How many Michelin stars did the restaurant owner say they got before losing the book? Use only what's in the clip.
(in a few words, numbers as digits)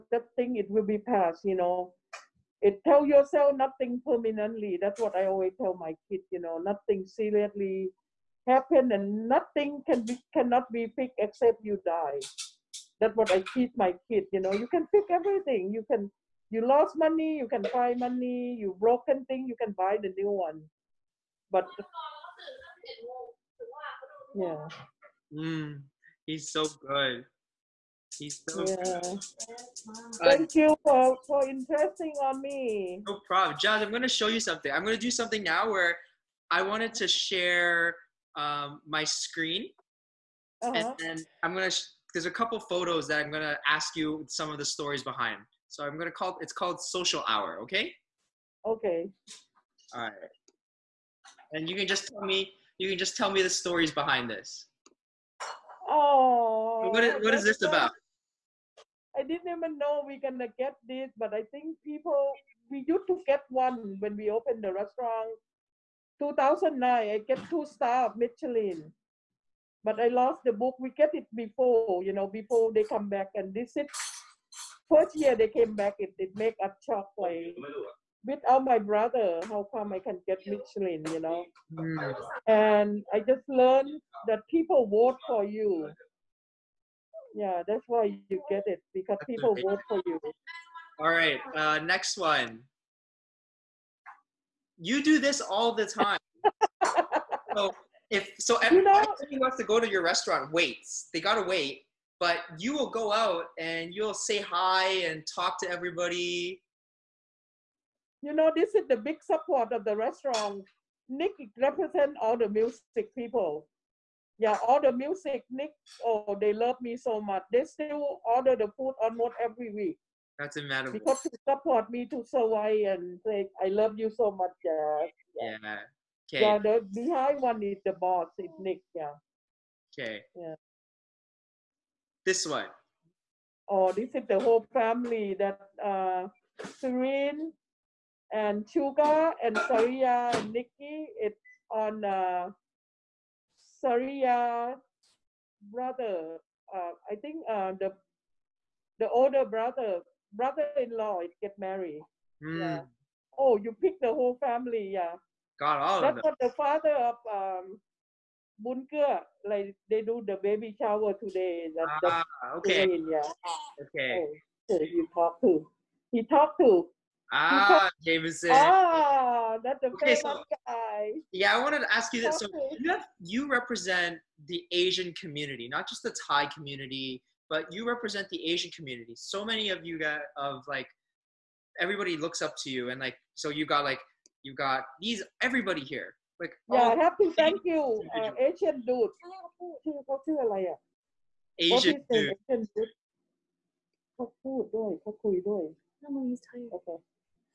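2.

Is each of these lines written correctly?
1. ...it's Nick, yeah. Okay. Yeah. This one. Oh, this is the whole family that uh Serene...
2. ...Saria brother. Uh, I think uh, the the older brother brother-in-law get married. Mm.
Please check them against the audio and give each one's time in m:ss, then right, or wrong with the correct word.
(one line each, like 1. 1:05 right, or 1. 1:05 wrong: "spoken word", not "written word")
1. 2:08 right
2. 2:23 right.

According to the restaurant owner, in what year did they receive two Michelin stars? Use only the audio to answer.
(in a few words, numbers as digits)
2009.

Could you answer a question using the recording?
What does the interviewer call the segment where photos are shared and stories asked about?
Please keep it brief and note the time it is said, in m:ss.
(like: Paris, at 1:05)
Social Hour, at 0:46.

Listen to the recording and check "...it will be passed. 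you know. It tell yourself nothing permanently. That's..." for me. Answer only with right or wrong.
right.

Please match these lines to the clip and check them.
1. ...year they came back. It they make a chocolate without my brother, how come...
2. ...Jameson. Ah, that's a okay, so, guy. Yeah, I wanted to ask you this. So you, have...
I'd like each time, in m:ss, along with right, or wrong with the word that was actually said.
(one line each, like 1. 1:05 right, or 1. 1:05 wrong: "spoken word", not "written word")
1. 1:15 right
2. 2:48 right.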